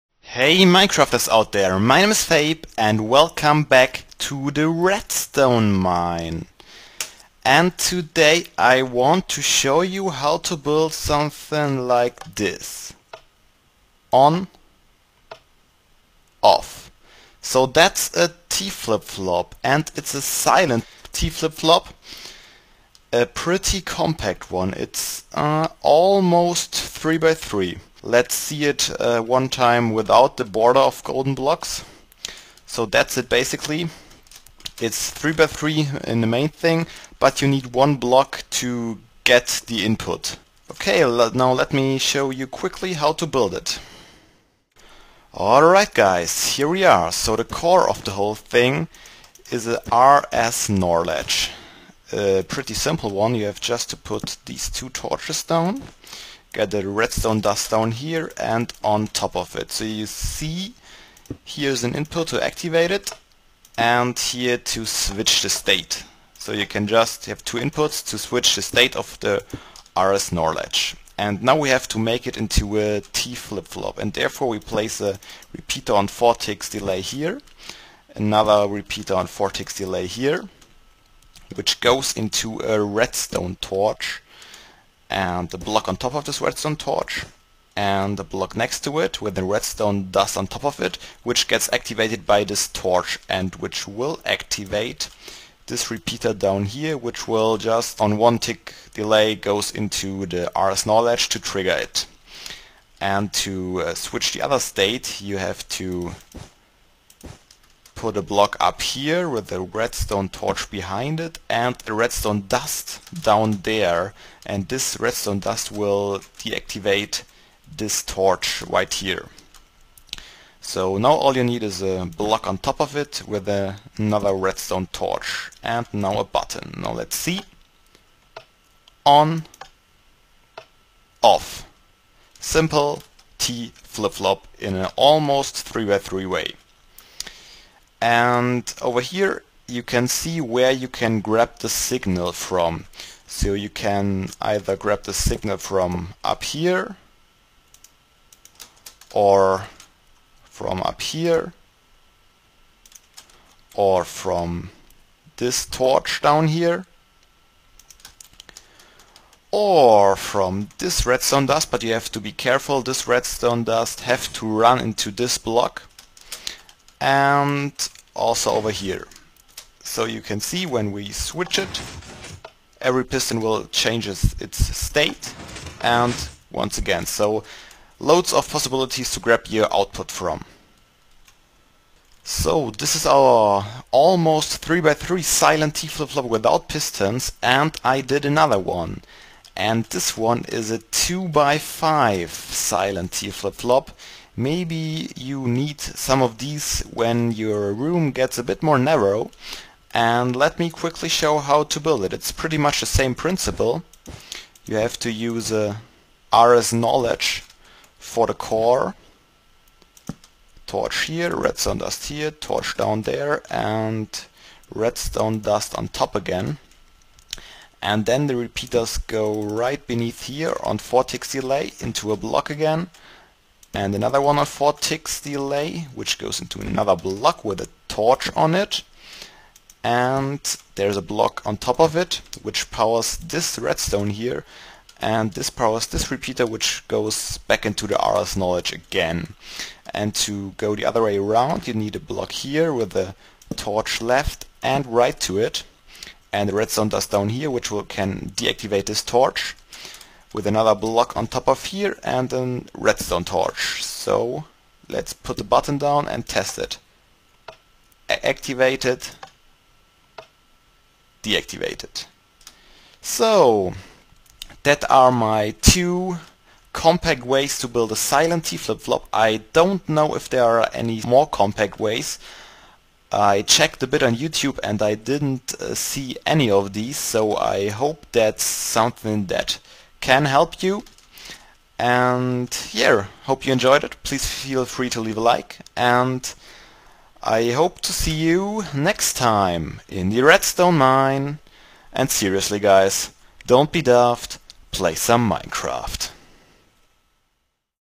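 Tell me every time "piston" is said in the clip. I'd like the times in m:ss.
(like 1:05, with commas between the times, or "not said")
2:53, 3:06.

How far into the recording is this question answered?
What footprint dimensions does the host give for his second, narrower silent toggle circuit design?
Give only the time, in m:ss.
3:10.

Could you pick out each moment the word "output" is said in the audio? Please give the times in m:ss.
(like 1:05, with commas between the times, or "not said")
2:59.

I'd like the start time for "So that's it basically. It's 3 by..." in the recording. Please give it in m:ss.
0:32.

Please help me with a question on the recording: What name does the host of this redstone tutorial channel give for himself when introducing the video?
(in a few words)
Fabe.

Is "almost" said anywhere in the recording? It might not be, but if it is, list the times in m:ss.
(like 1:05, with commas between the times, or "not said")
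0:25, 2:14, 3:03.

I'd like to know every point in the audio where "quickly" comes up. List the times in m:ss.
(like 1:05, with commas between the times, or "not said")
0:42, 3:20.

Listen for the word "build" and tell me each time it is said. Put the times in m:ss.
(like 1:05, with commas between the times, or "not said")
0:10, 0:43, 3:21, 4:27.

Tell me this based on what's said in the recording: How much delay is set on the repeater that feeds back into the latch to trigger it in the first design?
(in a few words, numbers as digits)
1 tick.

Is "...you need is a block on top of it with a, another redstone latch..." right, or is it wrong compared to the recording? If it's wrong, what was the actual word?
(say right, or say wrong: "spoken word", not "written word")
wrong: "torch", not "latch".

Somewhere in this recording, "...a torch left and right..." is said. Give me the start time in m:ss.
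4:02.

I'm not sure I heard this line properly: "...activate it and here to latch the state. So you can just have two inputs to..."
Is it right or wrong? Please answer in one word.
wrong.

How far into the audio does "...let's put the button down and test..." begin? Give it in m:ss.
4:14.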